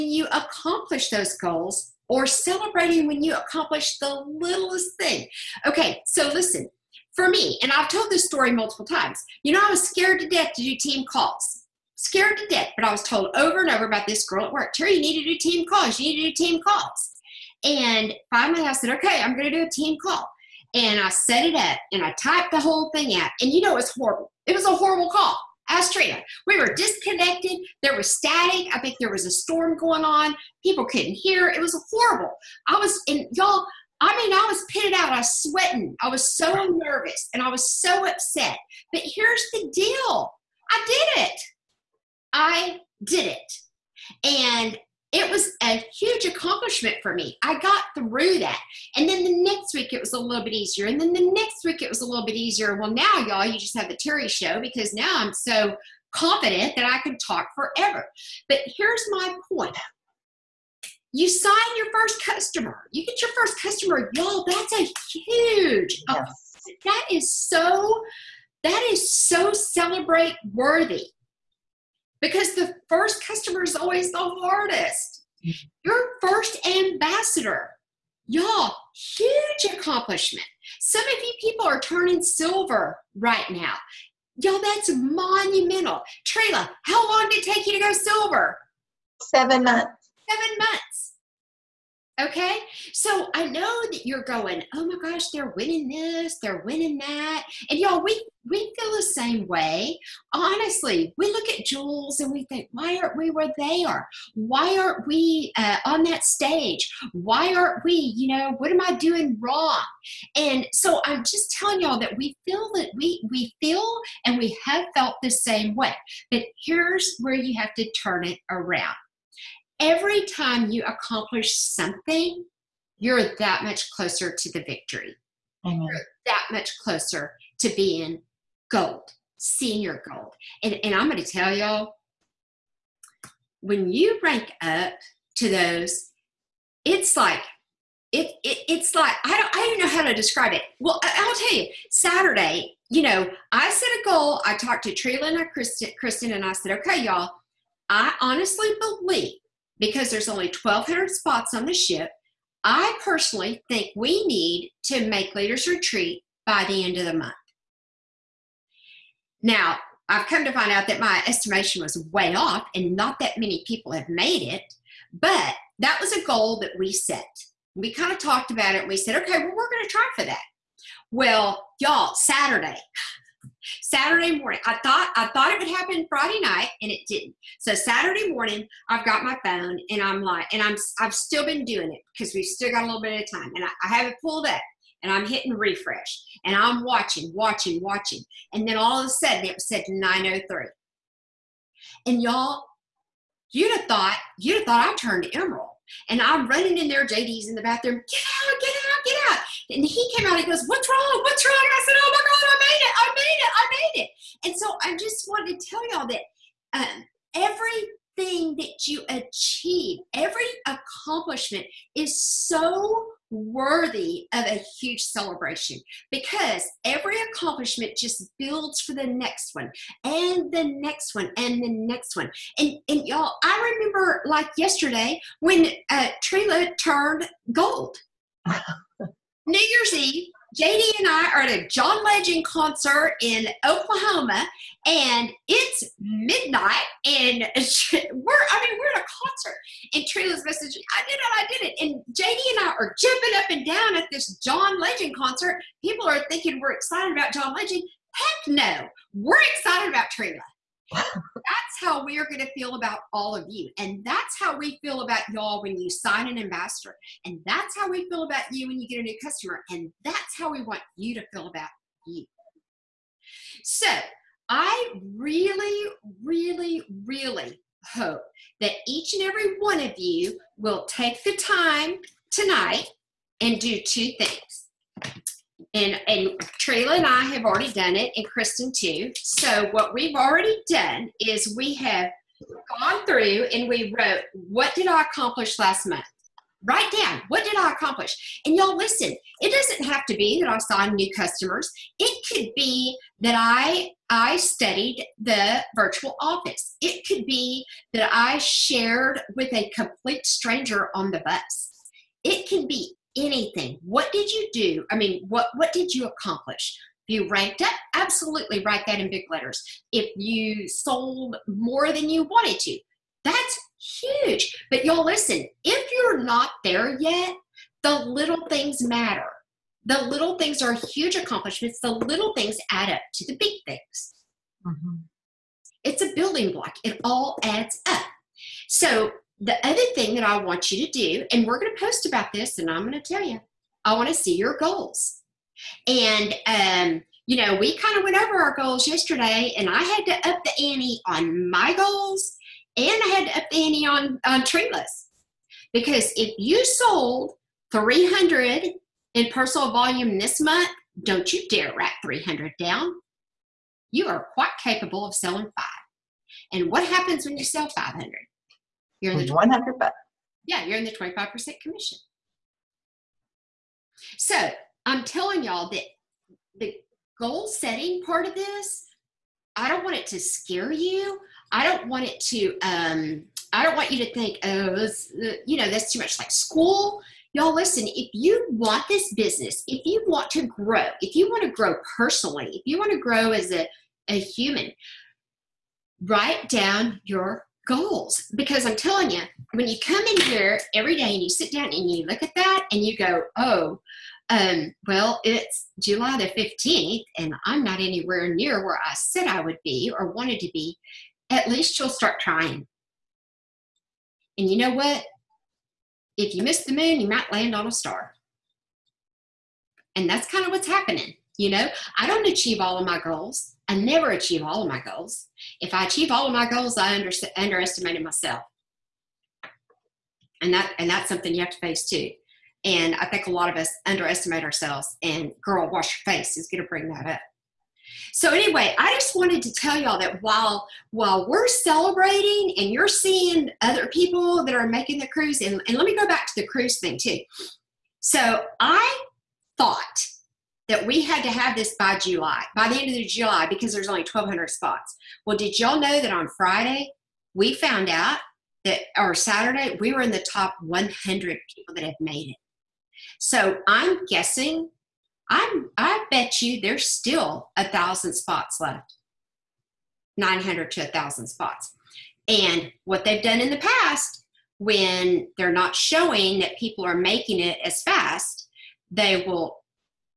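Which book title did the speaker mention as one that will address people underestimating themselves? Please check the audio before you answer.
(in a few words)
Girl, Wash Your Face.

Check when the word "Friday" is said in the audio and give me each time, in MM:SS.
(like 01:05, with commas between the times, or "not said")
02:56, 07:26.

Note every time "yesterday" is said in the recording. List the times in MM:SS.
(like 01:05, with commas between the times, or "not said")
03:44, 05:38.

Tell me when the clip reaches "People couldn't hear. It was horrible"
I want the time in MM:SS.
00:30.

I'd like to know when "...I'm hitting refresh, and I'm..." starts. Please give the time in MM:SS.
03:05.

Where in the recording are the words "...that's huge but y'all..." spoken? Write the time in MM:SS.
05:13.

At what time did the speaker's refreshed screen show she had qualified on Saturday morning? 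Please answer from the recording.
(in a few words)
9:03.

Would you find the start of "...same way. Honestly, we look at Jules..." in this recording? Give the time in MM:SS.
01:39.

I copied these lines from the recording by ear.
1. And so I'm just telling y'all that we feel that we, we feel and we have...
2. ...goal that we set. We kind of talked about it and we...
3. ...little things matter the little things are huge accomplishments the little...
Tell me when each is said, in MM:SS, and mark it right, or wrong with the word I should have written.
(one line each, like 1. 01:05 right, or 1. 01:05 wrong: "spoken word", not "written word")
1. 01:50 right
2. 02:46 right
3. 05:18 right.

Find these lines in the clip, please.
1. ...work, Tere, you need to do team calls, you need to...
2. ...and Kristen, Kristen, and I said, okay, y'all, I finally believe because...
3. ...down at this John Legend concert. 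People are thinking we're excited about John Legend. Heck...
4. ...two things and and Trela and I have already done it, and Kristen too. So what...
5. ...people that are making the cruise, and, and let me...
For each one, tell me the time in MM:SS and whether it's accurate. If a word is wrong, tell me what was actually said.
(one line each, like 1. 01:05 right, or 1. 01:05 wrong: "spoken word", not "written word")
1. 00:14 right
2. 02:25 wrong: "honestly", not "finally"
3. 04:03 right
4. 04:33 right
5. 07:13 right.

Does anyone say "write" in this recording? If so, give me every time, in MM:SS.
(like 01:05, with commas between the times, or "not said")
04:46, 05:08, 05:51, 06:26.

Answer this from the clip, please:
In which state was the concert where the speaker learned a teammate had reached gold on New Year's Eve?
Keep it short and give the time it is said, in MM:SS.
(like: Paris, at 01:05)
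Oklahoma, at 03:53.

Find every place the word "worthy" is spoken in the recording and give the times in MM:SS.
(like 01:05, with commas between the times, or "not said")
01:10, 03:33.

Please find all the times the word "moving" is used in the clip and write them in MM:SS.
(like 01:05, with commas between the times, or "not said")
not said.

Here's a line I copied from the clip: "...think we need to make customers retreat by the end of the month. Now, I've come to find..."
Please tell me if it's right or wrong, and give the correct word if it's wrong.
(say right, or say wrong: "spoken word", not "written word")
wrong: "leaders", not "customers".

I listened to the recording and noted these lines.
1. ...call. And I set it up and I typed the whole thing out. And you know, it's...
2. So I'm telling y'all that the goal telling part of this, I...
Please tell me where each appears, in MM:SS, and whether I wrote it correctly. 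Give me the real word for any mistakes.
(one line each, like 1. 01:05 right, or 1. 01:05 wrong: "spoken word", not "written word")
1. 00:20 right
2. 06:04 wrong: "setting", not "telling".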